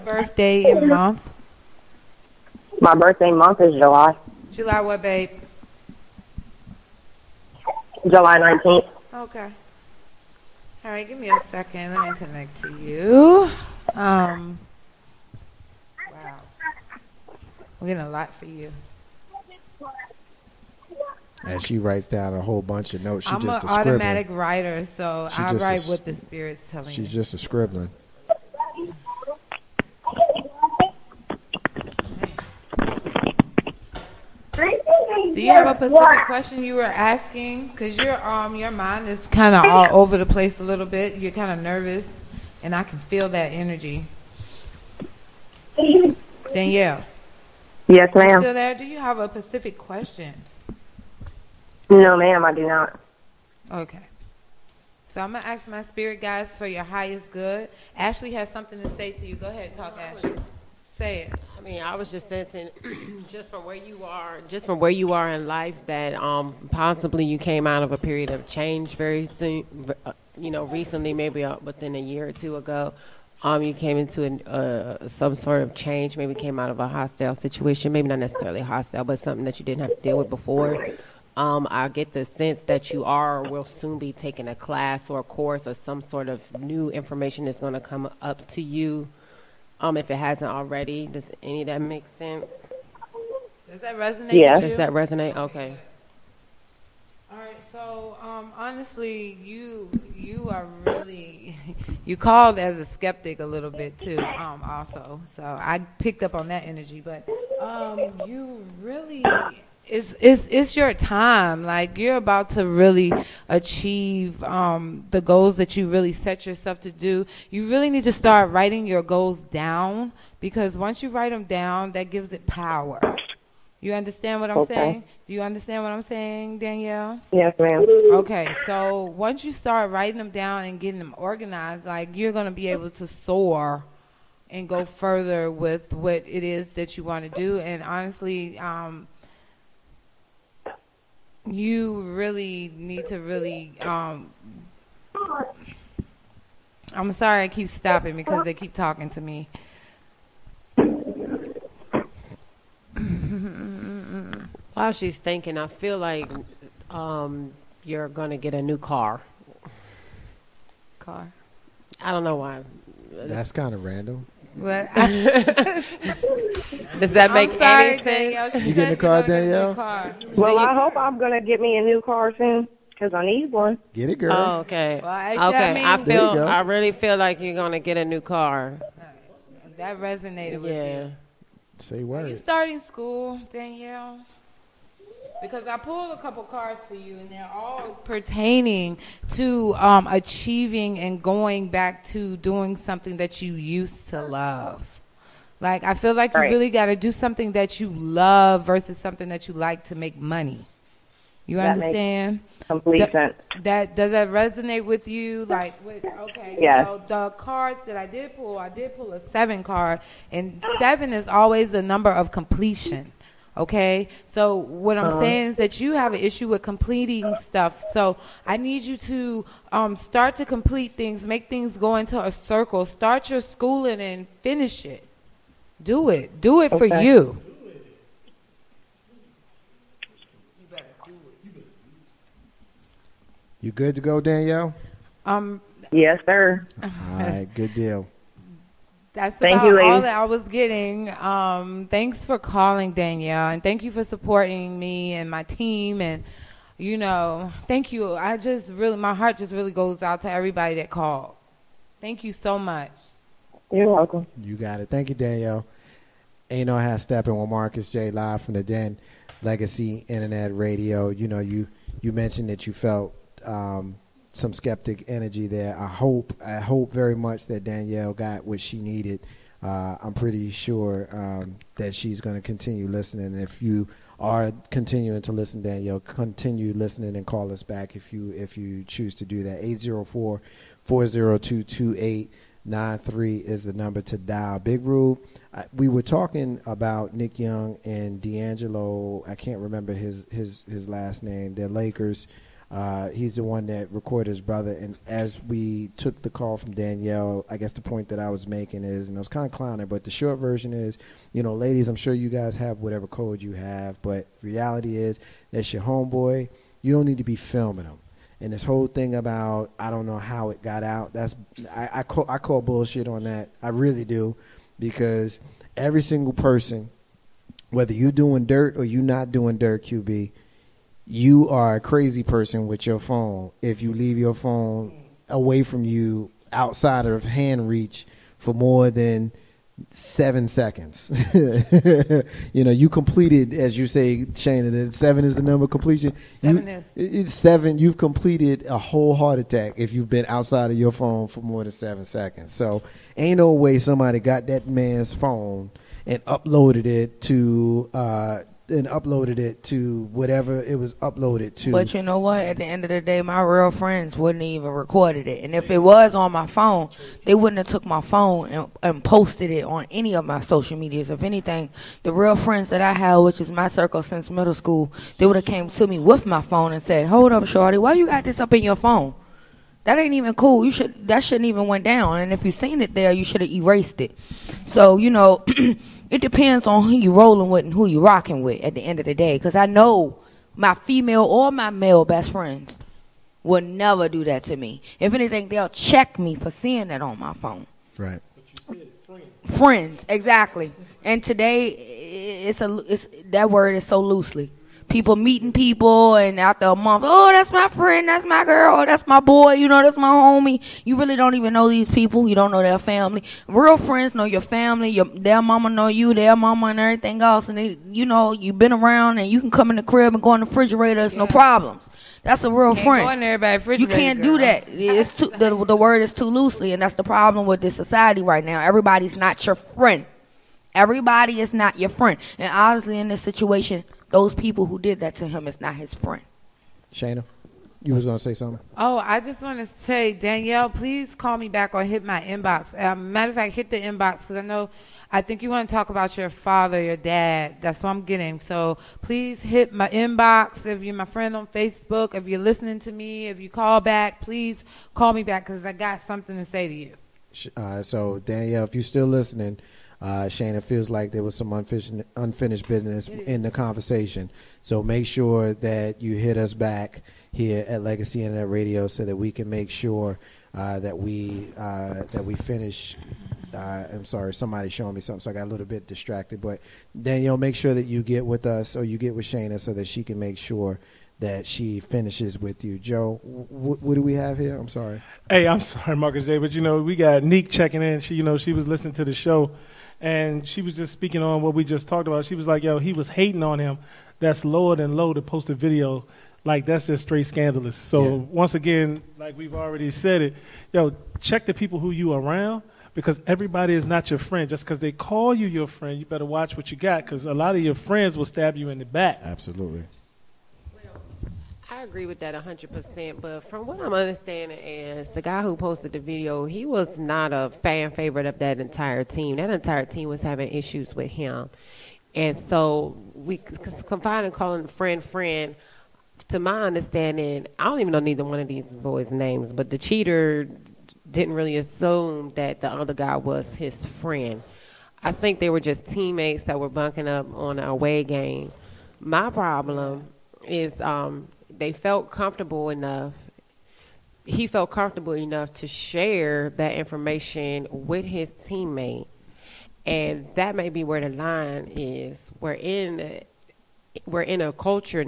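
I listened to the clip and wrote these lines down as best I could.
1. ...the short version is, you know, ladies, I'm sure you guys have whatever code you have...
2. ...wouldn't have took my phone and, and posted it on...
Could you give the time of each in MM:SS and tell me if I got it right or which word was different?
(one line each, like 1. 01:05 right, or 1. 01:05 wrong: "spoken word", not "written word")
1. 05:00 right
2. 05:57 right.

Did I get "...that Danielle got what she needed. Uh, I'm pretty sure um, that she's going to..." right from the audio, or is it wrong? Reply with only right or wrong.
right.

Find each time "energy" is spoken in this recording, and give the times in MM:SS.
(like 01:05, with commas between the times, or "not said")
00:43, 01:46, 04:25.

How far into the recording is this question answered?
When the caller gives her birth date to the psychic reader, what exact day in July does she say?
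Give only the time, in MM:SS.
00:08.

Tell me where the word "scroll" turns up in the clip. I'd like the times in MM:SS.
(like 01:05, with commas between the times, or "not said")
not said.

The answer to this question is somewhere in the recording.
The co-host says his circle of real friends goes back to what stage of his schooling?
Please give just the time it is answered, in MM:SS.
06:04.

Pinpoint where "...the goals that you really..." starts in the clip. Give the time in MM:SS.
01:55.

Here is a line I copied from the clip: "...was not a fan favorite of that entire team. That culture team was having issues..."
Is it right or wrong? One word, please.
wrong.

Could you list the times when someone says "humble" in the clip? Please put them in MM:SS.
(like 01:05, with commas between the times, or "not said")
not said.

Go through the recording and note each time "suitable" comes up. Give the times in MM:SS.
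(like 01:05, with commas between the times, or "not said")
not said.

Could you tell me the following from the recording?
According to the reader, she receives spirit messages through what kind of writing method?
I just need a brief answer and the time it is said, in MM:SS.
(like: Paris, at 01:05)
automatic scribbling, at 00:23.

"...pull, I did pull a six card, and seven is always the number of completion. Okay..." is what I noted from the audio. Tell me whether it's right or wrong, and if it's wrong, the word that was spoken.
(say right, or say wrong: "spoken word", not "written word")
wrong: "seven", not "six".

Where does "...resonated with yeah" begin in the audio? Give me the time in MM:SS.
03:00.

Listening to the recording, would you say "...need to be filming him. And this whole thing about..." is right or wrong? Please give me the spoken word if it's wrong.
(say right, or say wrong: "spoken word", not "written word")
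right.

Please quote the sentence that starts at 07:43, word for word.
Uh, I'm sorry, somebody showing me something, so I got a little bit distracted.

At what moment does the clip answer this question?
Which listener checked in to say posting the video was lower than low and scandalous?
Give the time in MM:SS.
07:57.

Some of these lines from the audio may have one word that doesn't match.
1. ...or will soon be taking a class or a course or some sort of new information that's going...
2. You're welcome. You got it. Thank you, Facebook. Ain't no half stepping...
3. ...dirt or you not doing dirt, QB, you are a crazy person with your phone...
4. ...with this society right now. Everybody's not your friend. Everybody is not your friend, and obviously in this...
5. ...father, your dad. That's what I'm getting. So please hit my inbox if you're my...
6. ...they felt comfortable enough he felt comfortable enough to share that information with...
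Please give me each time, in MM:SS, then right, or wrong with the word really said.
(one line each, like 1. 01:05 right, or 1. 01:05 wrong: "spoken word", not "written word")
1. 01:23 right
2. 04:13 wrong: "Danielle", not "Facebook"
3. 05:18 right
4. 06:57 right
5. 07:16 right
6. 08:51 right.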